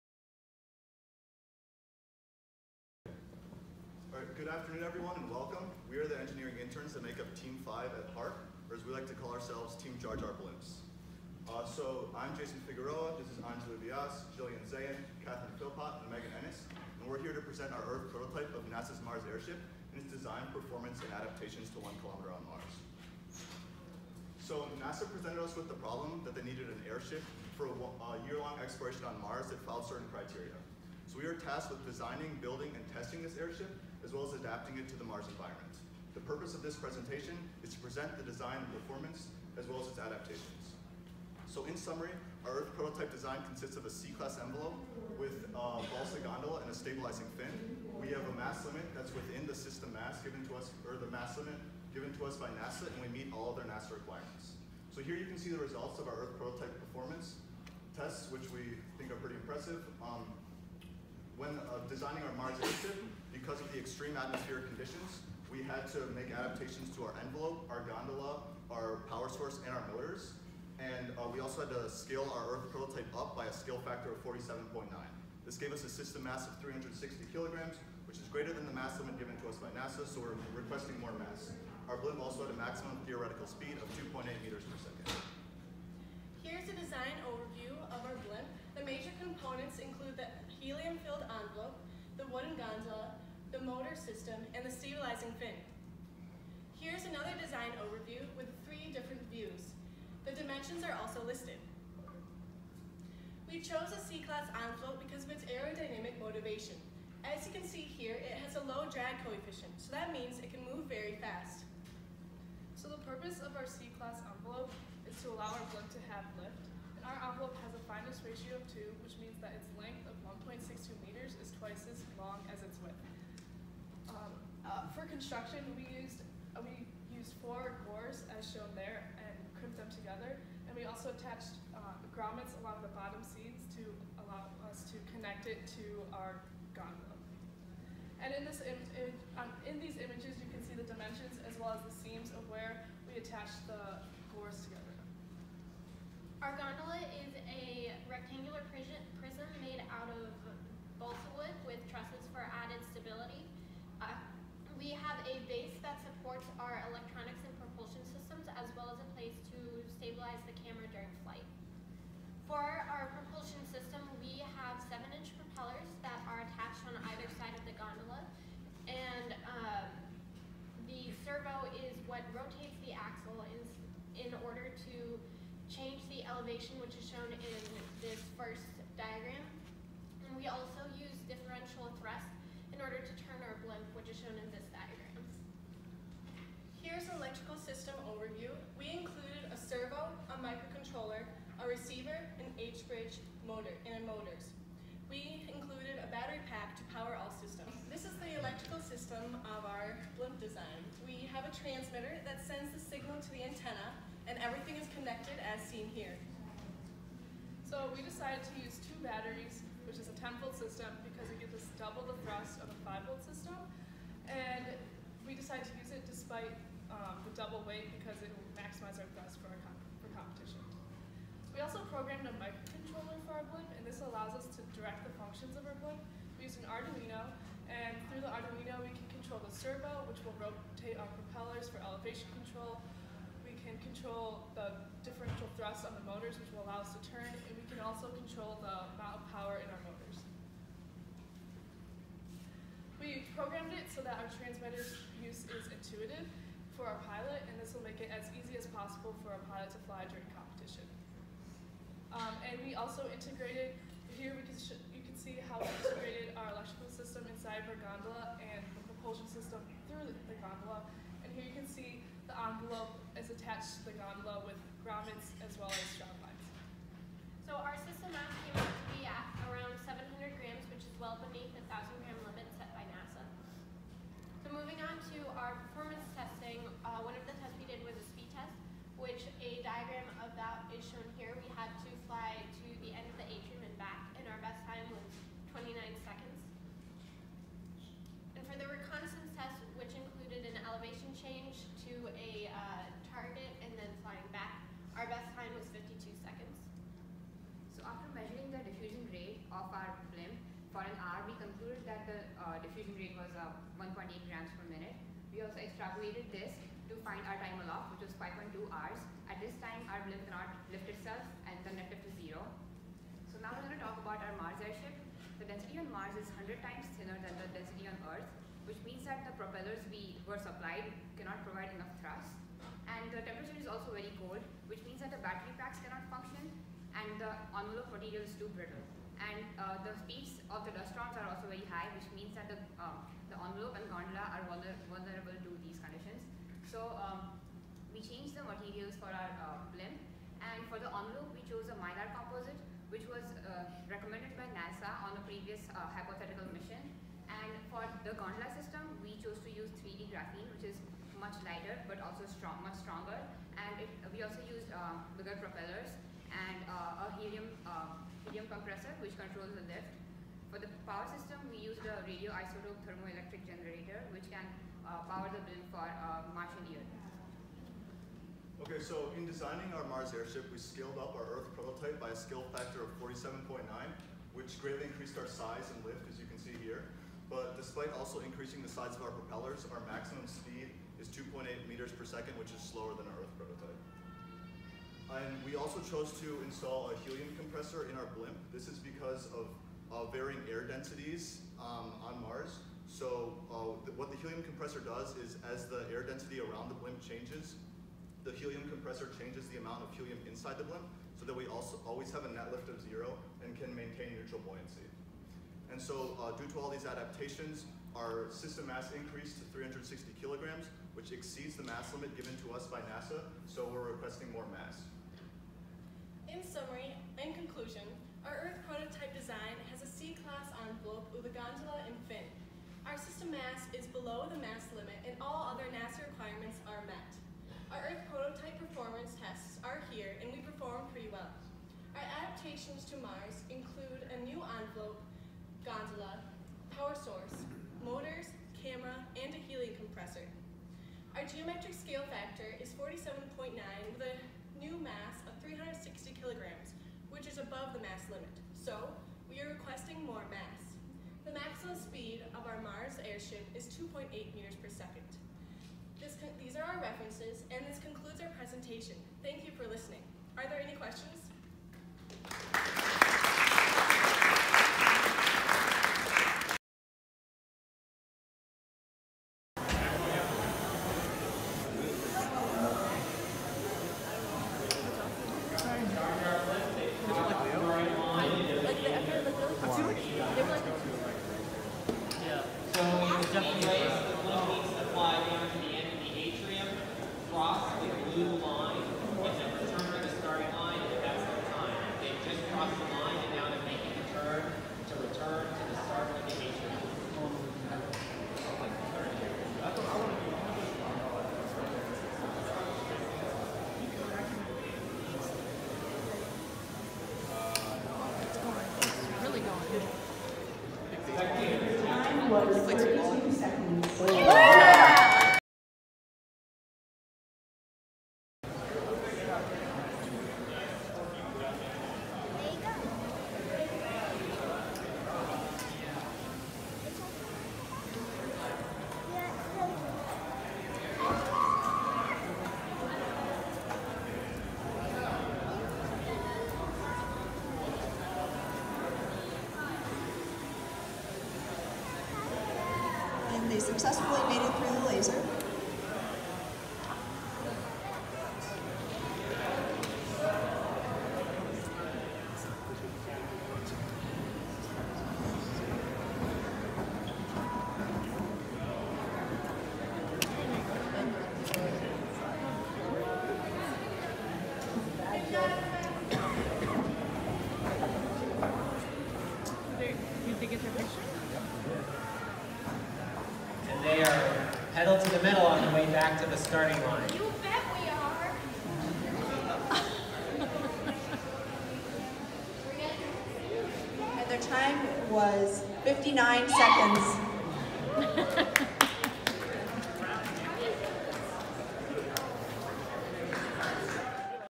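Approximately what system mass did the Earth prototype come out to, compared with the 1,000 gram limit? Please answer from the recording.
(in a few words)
700 grams.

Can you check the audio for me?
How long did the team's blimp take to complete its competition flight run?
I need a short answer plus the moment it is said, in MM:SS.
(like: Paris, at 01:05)
59 seconds, at 09:45.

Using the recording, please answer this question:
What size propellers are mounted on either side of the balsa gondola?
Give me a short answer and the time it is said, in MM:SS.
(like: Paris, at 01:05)
7-inch, at 02:44.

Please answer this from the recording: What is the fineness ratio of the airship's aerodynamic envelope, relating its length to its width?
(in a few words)
2.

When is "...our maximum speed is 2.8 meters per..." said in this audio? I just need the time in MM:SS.
06:19.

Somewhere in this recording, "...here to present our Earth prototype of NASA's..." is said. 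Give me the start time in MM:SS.
00:17.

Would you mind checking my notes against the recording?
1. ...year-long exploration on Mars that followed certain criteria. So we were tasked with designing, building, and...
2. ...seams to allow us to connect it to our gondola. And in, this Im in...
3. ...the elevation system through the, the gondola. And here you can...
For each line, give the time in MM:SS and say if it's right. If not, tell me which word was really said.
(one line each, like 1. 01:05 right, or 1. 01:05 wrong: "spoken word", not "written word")
1. 00:28 right
2. 02:13 right
3. 04:18 wrong: "propulsion", not "elevation".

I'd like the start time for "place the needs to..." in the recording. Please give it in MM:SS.
08:03.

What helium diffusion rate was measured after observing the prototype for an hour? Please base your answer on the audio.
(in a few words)
1.8 grams per minute.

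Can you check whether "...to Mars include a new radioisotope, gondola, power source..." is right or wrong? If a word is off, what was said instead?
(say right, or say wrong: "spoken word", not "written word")
wrong: "envelope", not "radioisotope".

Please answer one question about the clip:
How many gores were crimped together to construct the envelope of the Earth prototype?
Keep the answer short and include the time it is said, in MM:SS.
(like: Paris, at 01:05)
4, at 02:07.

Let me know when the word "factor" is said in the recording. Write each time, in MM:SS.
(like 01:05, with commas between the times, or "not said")
01:13, 06:12, 07:22.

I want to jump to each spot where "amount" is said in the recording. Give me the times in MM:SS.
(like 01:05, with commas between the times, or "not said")
03:58, 06:39.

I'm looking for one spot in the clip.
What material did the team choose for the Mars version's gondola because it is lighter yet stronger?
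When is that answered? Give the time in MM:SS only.
05:49.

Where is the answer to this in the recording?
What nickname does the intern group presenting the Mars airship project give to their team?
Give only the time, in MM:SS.
00:09.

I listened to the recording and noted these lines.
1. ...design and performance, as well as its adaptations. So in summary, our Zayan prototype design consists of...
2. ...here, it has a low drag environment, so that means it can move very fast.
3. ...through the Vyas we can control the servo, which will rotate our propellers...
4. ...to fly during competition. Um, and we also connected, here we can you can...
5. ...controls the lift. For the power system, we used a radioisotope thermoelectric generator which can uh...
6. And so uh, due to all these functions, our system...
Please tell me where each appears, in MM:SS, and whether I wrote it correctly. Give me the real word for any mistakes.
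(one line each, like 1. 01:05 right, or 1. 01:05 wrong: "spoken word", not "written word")
1. 00:38 wrong: "Earth", not "Zayan"
2. 01:47 wrong: "coefficient", not "environment"
3. 03:48 wrong: "Arduino", not "Vyas"
4. 04:09 wrong: "integrated", not "connected"
5. 05:59 right
6. 06:45 wrong: "adaptations", not "functions".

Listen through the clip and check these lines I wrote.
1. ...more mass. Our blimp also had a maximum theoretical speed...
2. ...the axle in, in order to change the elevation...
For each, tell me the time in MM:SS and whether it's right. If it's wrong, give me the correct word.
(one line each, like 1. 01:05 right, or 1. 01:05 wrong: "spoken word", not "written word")
1. 01:20 right
2. 02:52 right.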